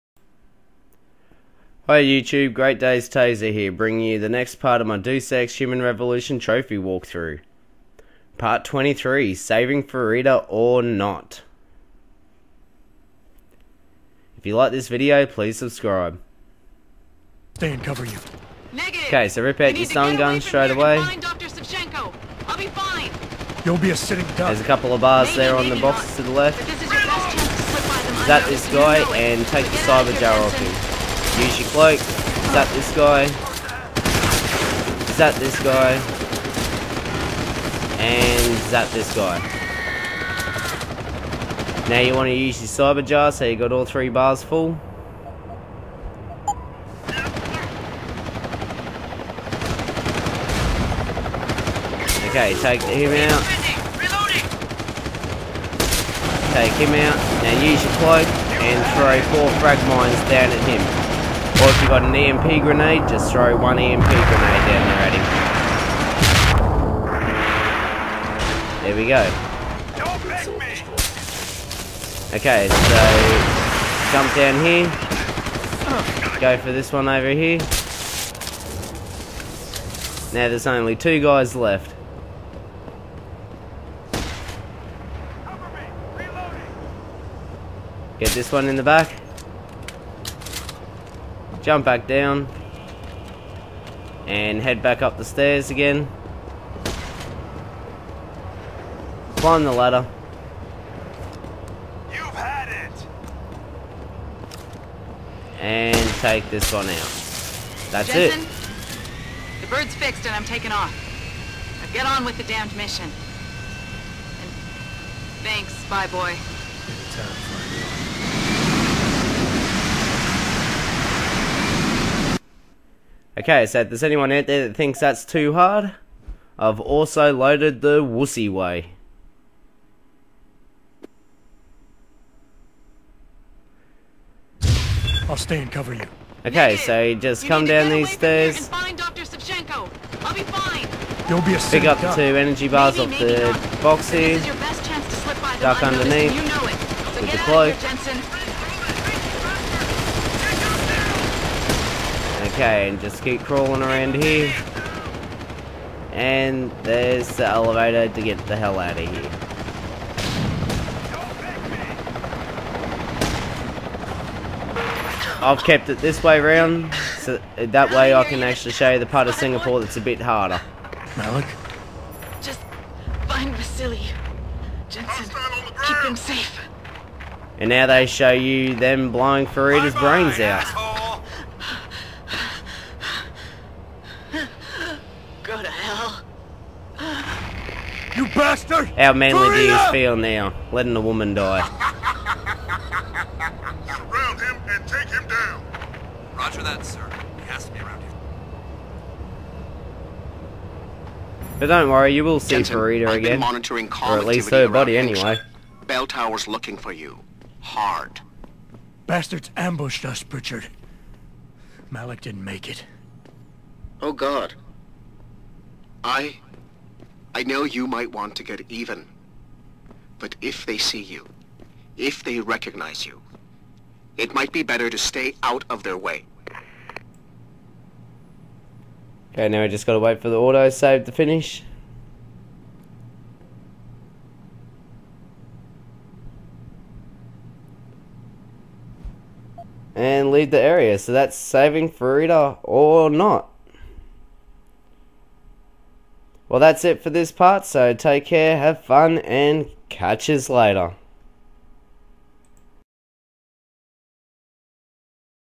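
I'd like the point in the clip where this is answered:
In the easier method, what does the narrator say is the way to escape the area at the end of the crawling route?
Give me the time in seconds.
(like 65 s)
157 s.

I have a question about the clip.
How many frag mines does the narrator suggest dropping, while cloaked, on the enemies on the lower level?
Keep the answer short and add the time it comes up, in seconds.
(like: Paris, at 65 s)
4, at 59 s.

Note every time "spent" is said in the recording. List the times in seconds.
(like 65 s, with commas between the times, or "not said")
not said.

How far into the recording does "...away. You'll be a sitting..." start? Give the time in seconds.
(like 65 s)
20 s.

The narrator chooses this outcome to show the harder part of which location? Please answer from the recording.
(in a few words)
Singapore.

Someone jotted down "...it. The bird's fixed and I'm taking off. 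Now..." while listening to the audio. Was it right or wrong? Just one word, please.
right.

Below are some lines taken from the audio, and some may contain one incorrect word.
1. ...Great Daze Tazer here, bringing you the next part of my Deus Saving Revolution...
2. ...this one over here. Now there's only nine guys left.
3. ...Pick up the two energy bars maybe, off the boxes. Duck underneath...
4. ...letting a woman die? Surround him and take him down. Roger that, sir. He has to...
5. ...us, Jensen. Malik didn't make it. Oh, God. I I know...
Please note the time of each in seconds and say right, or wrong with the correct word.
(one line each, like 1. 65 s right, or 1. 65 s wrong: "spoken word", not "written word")
1. 2 s wrong: "Human", not "Saving"
2. 76 s wrong: "two", not "nine"
3. 141 s right
4. 190 s right
5. 210 s wrong: "Pritchard", not "Jensen".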